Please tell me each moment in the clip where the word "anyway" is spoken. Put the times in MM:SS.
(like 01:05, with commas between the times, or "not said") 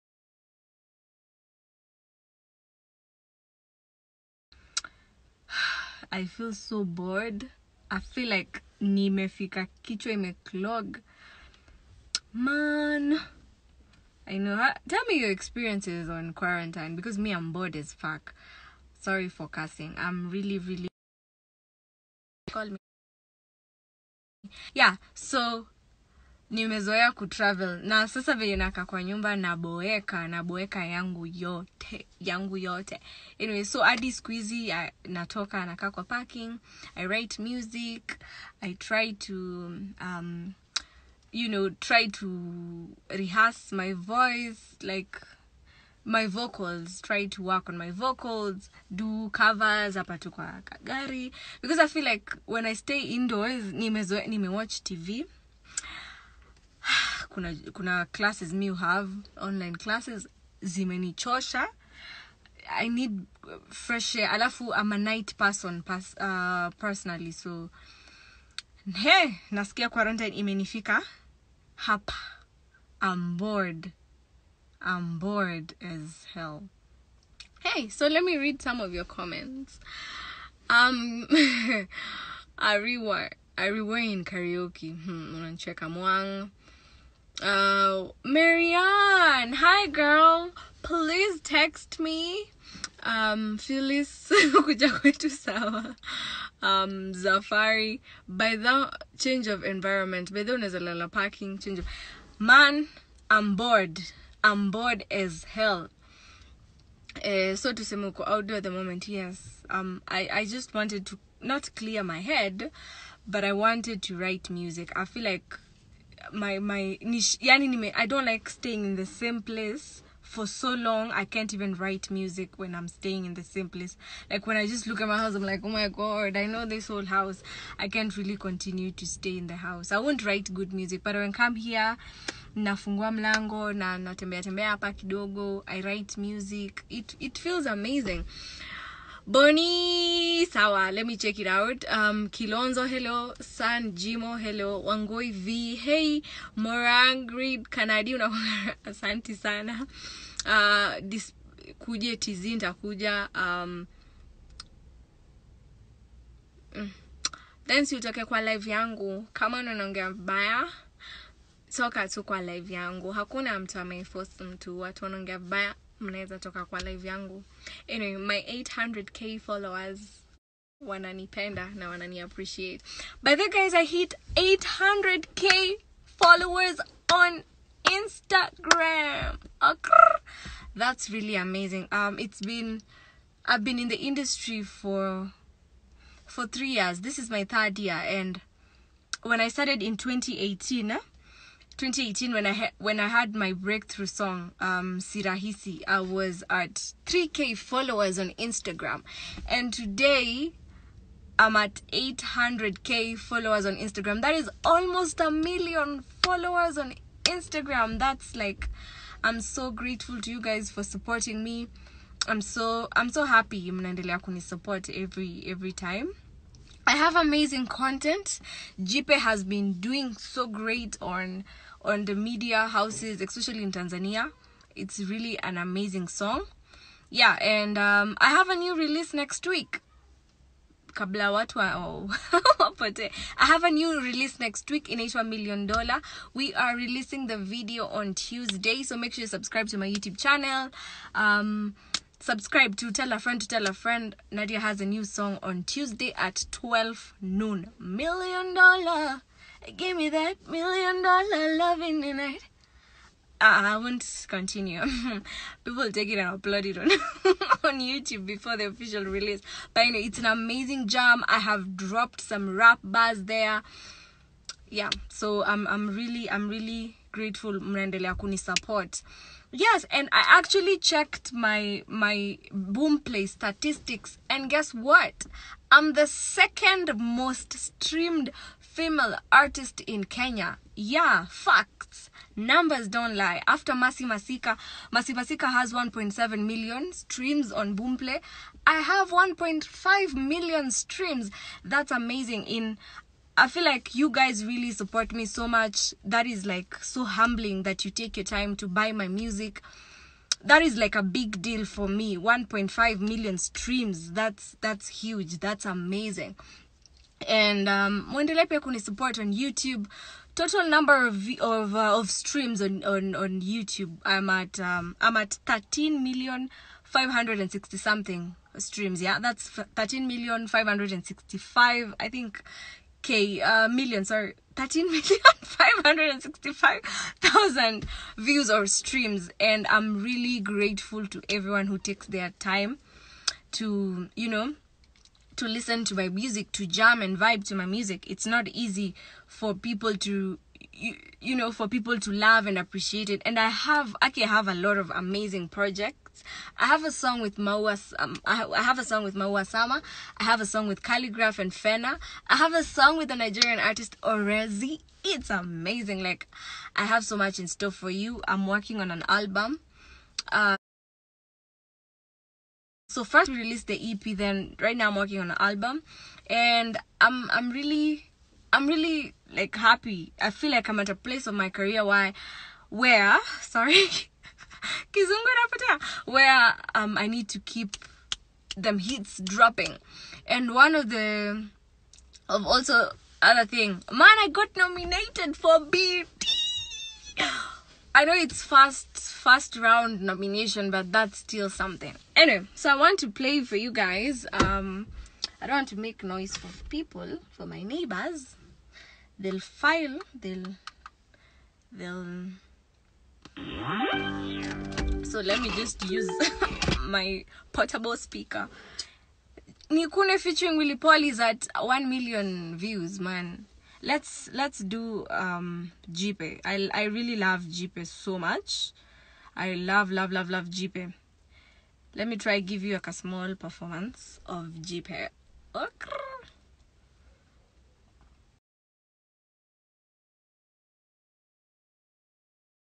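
00:33, 02:47, 06:32.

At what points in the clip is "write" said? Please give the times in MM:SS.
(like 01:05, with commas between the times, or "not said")
00:37, 01:54, 02:01, 02:10, 02:15.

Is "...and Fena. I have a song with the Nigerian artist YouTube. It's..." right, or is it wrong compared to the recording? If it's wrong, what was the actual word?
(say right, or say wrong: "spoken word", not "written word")
wrong: "Orezi", not "YouTube".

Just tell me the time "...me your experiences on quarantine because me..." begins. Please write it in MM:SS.
00:15.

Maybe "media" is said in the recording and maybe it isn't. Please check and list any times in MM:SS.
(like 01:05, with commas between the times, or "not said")
03:42.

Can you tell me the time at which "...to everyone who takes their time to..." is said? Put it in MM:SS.
05:31.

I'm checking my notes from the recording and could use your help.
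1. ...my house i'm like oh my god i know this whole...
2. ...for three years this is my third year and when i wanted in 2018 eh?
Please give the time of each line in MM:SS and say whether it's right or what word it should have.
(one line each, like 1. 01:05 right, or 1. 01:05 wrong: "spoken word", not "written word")
1. 02:05 right
2. 03:06 wrong: "started", not "wanted".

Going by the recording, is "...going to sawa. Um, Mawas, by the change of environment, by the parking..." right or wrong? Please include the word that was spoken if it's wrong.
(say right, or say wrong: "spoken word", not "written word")
wrong: "Zafari", not "Mawas".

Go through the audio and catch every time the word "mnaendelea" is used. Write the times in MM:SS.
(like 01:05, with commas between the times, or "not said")
03:33, 04:27.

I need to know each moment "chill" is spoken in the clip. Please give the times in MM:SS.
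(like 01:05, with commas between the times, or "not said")
not said.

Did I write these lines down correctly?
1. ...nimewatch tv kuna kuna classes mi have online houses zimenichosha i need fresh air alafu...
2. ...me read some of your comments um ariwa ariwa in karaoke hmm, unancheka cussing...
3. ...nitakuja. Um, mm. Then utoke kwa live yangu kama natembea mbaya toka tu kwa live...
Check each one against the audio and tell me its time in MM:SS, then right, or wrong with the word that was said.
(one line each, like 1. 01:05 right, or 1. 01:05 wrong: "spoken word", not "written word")
1. 00:53 wrong: "classes", not "houses"
2. 01:18 wrong: "mwang", not "cussing"
3. 02:32 wrong: "unaongea", not "natembea".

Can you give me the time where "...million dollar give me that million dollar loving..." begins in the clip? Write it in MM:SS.
04:07.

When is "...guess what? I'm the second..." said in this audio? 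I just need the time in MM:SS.
04:34.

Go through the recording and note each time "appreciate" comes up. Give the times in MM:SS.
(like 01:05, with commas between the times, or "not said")
02:52, 05:42.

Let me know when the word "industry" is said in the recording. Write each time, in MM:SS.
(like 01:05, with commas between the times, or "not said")
03:03.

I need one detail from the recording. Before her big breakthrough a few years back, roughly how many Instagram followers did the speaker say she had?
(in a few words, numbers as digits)
3k.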